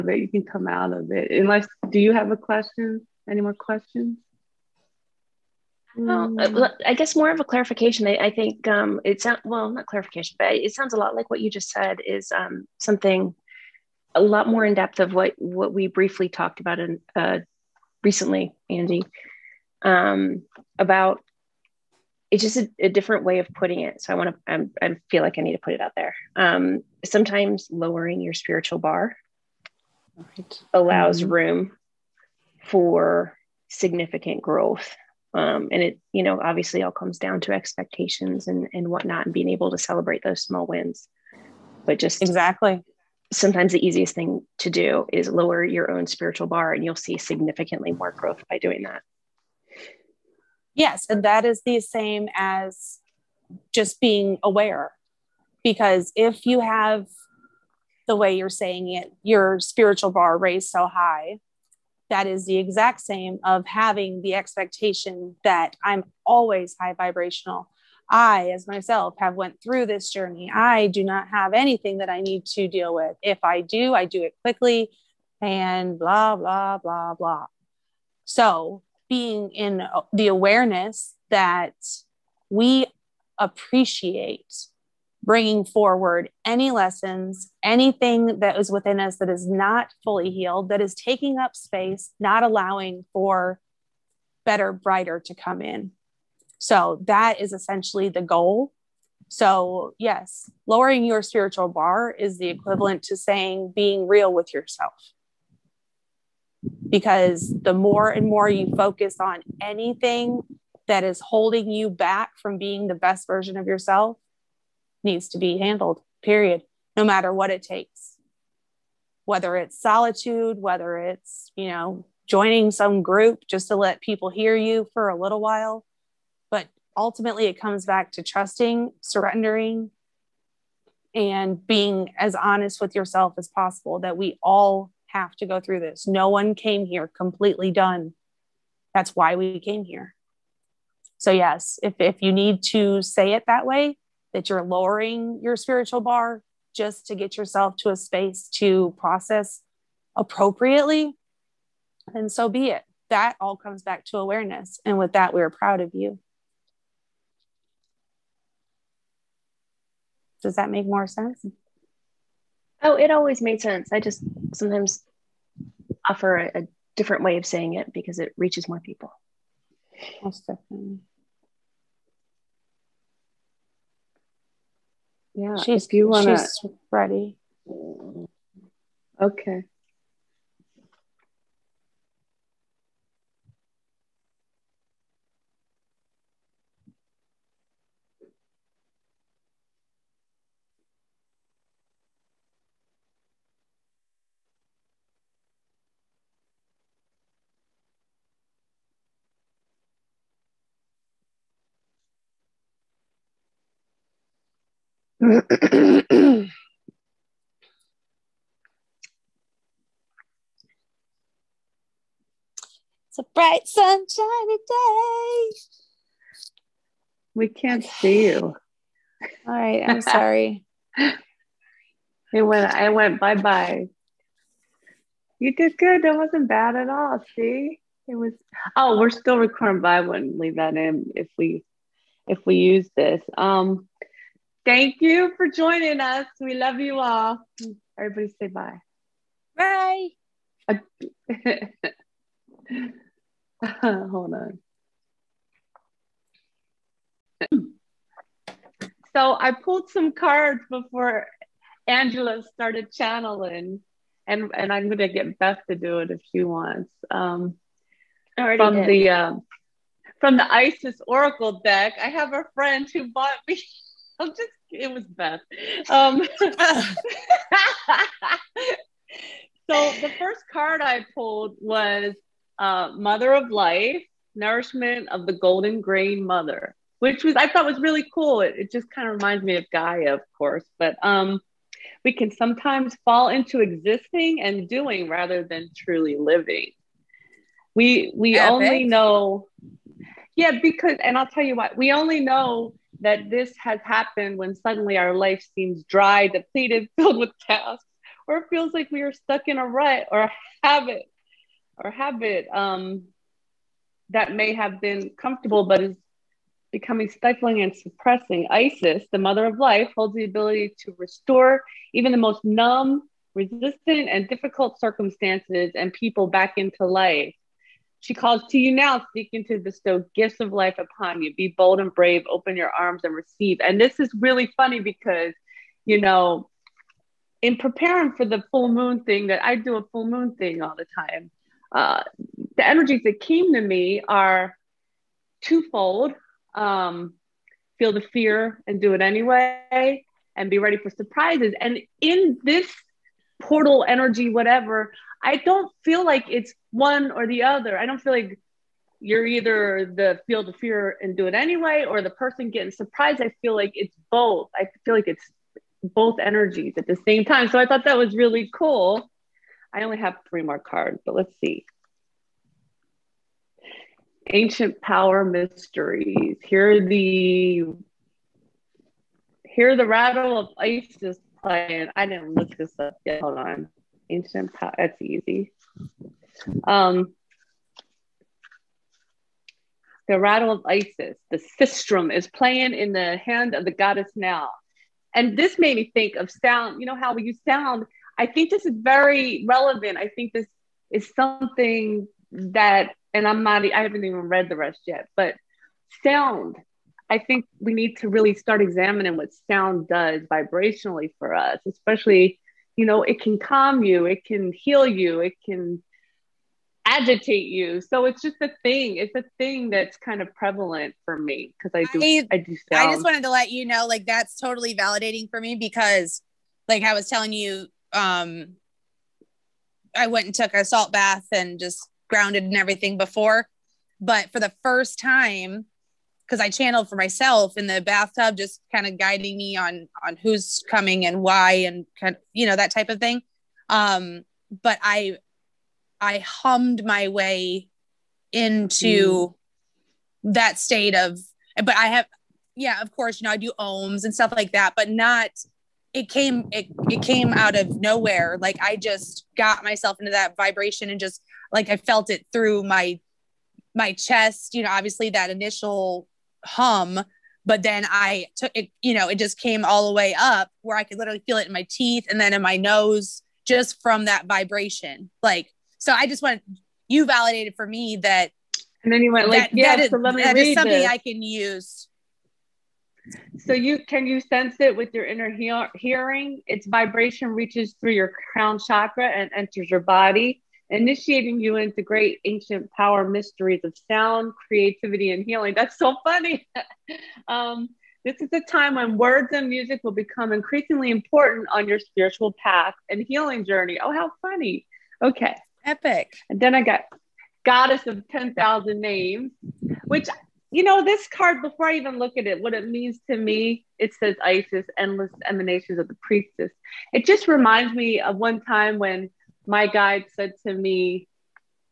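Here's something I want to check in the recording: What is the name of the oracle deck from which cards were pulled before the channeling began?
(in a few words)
Isis Oracle deck.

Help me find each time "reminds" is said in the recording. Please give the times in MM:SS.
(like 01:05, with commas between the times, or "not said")
04:39, 08:27.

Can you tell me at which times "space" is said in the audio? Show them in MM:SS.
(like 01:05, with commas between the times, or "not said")
01:31, 02:27.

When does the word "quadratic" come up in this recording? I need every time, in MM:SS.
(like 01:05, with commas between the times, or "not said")
not said.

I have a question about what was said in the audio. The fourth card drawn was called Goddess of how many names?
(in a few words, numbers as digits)
10,000.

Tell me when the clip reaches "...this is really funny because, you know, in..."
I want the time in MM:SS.
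05:23.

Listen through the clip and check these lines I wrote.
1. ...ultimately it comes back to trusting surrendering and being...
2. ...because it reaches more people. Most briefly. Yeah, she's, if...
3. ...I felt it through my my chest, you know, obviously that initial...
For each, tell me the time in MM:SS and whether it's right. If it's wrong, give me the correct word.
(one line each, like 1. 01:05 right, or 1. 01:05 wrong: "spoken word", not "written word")
1. 02:06 right
2. 02:47 wrong: "definitely", not "briefly"
3. 07:31 right.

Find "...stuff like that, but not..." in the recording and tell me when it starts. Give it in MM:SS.
07:24.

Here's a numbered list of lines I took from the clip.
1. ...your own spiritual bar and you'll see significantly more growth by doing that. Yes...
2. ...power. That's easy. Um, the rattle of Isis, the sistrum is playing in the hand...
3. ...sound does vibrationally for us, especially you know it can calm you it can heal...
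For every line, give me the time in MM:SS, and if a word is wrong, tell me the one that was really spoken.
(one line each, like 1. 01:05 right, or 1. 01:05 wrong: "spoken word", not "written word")
1. 00:45 right
2. 06:14 right
3. 06:39 right.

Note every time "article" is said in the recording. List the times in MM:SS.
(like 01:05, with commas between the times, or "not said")
not said.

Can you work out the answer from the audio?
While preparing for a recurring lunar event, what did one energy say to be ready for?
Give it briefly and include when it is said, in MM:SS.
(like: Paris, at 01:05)
Surprises, at 05:40.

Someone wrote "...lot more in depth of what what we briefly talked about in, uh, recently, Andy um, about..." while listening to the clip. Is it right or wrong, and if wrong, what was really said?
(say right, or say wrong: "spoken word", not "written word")
right.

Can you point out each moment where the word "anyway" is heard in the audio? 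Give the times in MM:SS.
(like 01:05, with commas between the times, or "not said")
05:39, 05:51.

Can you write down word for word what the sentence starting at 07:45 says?
Like, so I just want you validated for me that.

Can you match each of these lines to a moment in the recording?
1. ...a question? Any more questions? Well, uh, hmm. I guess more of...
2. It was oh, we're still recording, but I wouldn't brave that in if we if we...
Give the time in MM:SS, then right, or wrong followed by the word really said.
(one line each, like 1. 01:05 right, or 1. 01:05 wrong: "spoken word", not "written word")
1. 00:02 right
2. 03:48 wrong: "leave", not "brave".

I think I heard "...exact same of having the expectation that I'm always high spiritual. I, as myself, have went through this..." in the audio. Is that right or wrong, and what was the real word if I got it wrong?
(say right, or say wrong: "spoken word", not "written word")
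wrong: "vibrational", not "spiritual".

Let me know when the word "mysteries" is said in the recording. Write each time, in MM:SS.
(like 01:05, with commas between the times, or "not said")
06:05, 08:03.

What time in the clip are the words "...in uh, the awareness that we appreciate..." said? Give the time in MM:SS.
01:19.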